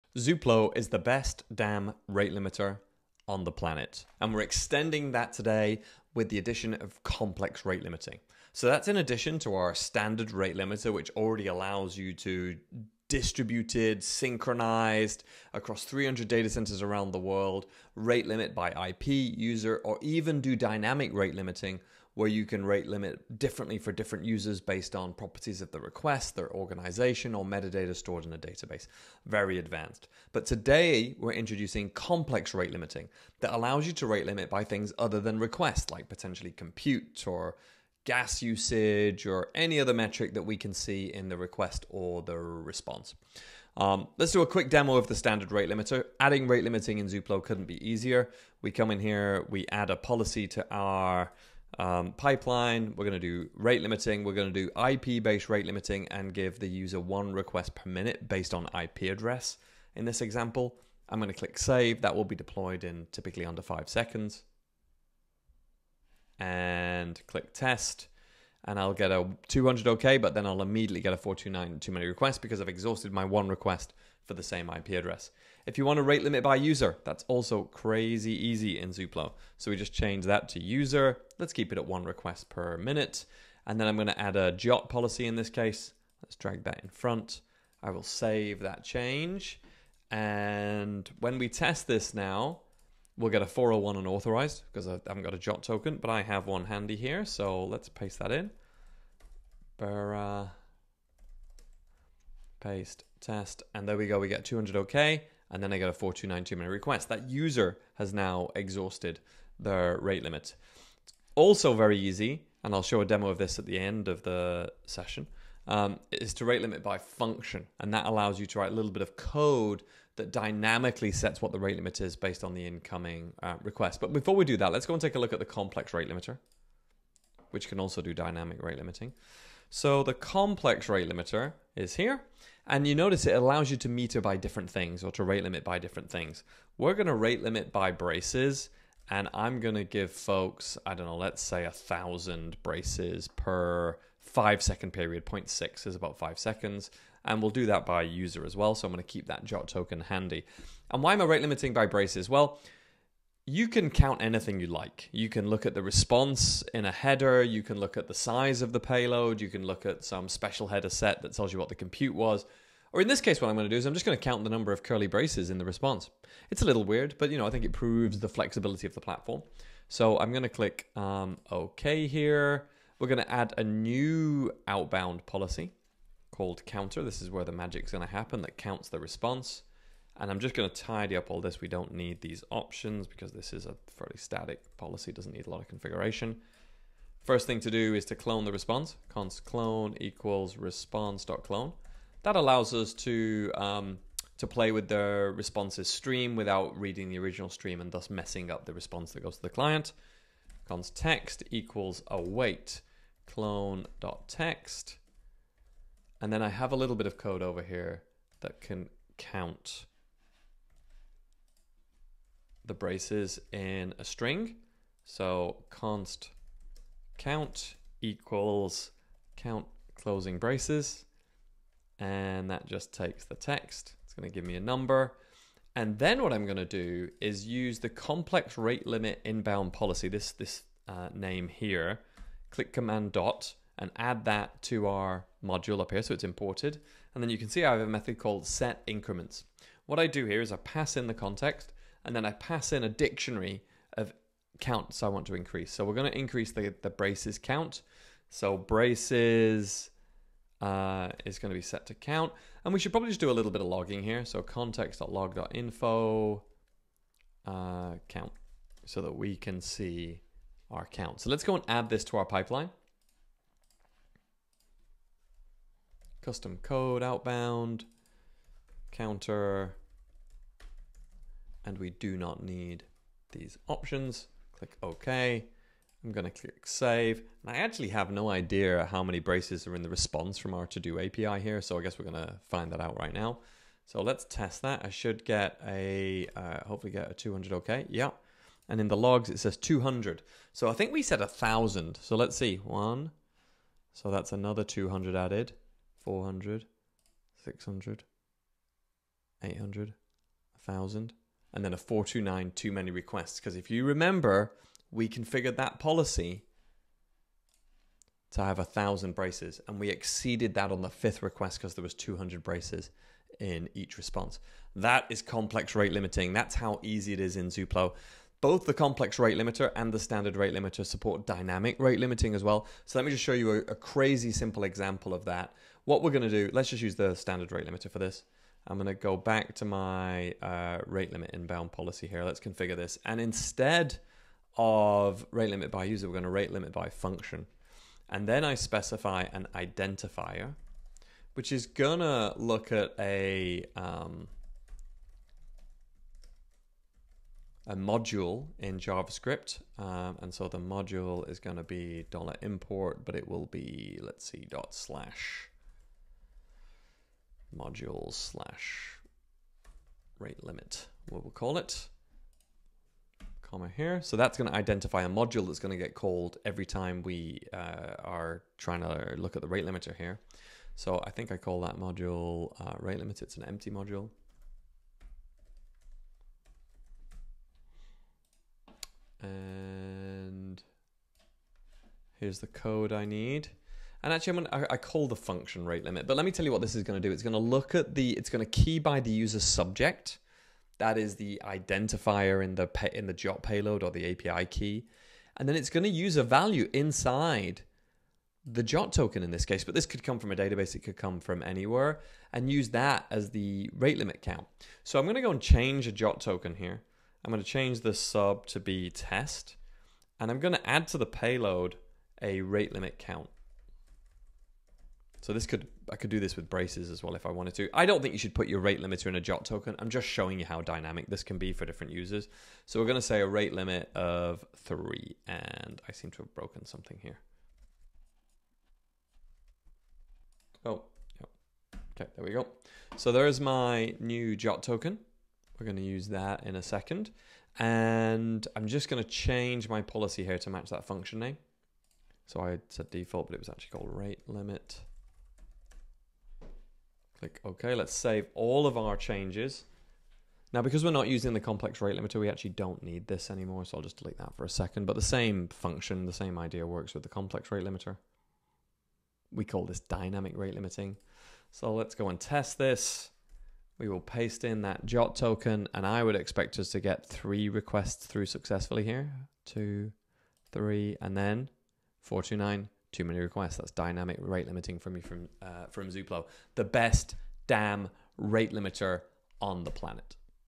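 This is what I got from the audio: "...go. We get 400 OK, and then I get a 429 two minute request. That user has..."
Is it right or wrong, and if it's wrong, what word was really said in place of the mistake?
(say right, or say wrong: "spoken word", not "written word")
wrong: "200", not "400".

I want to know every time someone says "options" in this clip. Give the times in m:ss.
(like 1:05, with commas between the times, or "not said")
3:02, 4:33.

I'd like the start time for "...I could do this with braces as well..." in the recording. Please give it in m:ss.
6:55.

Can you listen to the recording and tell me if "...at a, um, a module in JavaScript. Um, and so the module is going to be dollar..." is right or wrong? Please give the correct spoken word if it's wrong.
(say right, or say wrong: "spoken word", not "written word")
right.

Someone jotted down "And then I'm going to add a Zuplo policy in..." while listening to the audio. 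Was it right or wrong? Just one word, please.
wrong.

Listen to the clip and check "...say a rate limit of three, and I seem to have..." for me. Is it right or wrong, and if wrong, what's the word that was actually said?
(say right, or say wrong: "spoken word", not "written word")
right.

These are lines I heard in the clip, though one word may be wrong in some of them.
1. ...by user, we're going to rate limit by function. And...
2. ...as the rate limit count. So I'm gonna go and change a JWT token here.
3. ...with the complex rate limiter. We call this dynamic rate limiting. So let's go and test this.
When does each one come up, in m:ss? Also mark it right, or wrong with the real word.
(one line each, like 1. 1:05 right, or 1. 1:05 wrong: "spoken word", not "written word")
1. 5:35 right
2. 6:43 right
3. 7:36 right.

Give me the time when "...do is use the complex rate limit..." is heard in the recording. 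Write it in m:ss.
3:46.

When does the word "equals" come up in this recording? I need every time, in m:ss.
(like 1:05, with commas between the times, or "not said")
3:09, 3:21, 3:38.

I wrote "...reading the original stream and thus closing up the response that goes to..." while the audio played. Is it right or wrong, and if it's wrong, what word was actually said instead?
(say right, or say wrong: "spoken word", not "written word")
wrong: "messing", not "closing".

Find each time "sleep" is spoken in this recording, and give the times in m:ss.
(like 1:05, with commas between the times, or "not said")
not said.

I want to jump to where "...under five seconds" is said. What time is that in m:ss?
1:03.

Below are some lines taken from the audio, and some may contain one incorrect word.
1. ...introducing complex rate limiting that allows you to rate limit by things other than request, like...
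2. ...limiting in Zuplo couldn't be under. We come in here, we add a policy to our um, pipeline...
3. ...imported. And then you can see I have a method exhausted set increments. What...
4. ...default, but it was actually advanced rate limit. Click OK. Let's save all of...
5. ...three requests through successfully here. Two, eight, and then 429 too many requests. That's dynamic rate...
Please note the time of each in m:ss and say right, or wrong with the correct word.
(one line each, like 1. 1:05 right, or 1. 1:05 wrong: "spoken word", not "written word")
1. 0:31 right
2. 0:46 wrong: "easier", not "under"
3. 3:56 wrong: "called", not "exhausted"
4. 7:22 wrong: "called", not "advanced"
5. 7:47 wrong: "three", not "eight".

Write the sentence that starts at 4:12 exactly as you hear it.
And we should probably just do a little bit of logging here.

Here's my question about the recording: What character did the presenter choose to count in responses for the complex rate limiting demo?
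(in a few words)
Curly braces.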